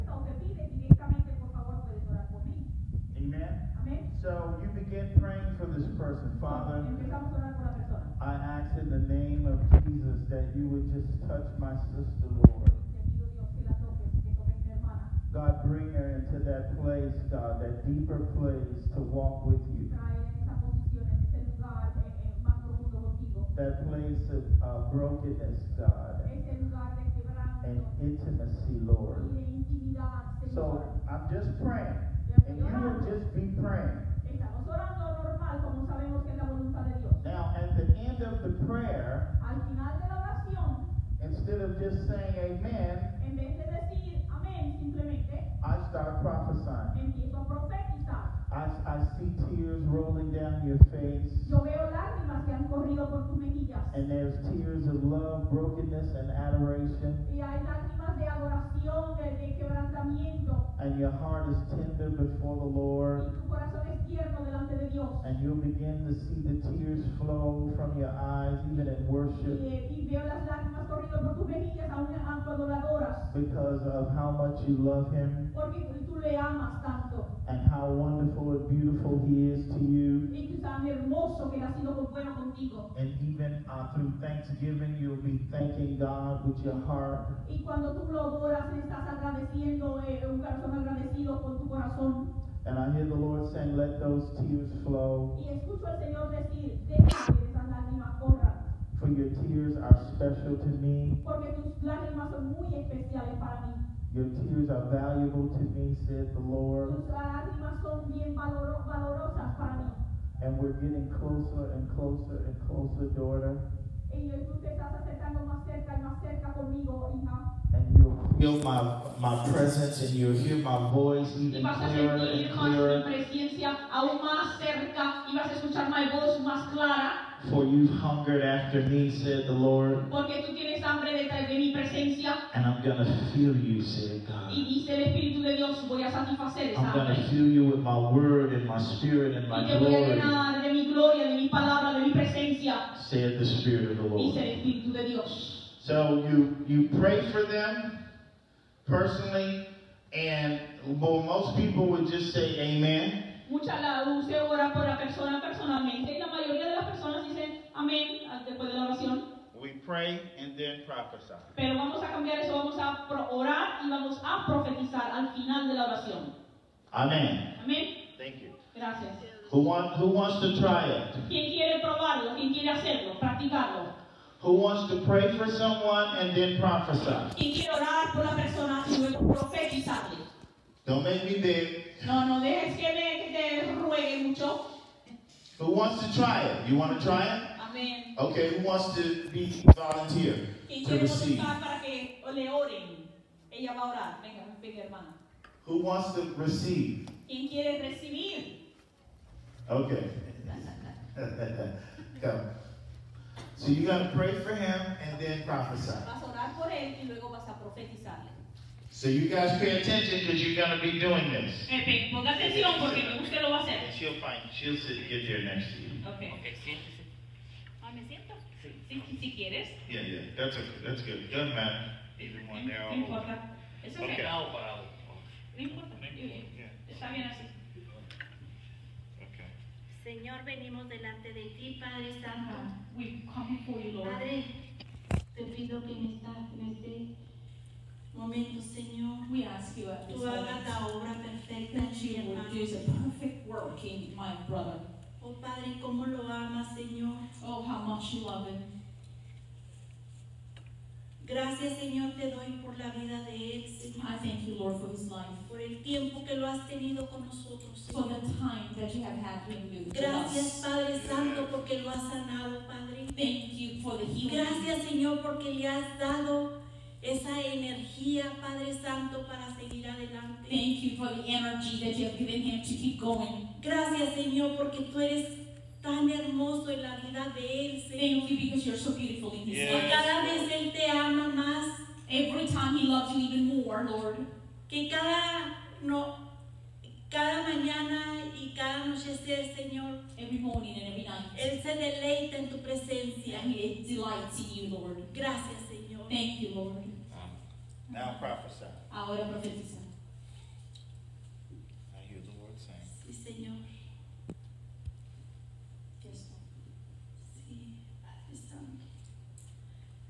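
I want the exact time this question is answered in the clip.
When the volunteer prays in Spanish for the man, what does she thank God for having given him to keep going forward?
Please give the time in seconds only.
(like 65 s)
271 s.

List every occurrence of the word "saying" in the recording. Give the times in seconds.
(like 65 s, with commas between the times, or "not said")
42 s, 93 s.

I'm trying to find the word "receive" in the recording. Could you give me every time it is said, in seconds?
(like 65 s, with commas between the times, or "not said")
190 s, 196 s.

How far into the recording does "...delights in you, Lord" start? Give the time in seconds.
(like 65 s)
293 s.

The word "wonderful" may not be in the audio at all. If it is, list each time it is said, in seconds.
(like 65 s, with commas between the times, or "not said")
77 s.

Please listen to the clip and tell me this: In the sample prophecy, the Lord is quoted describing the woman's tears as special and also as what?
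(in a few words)
valuable.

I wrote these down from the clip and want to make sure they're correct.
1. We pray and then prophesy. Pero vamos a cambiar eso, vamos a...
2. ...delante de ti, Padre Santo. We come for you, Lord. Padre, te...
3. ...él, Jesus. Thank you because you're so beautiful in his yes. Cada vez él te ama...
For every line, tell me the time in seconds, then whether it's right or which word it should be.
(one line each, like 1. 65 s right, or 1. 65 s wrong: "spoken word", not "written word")
1. 159 s right
2. 230 s right
3. 277 s wrong: "Señor", not "Jesus".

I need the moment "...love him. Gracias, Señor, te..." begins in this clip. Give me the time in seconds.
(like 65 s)
248 s.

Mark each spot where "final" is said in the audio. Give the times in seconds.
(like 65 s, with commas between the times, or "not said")
39 s, 165 s.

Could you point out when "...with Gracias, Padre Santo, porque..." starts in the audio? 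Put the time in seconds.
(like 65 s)
259 s.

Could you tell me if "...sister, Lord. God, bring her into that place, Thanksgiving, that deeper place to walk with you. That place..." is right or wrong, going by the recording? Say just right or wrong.
wrong.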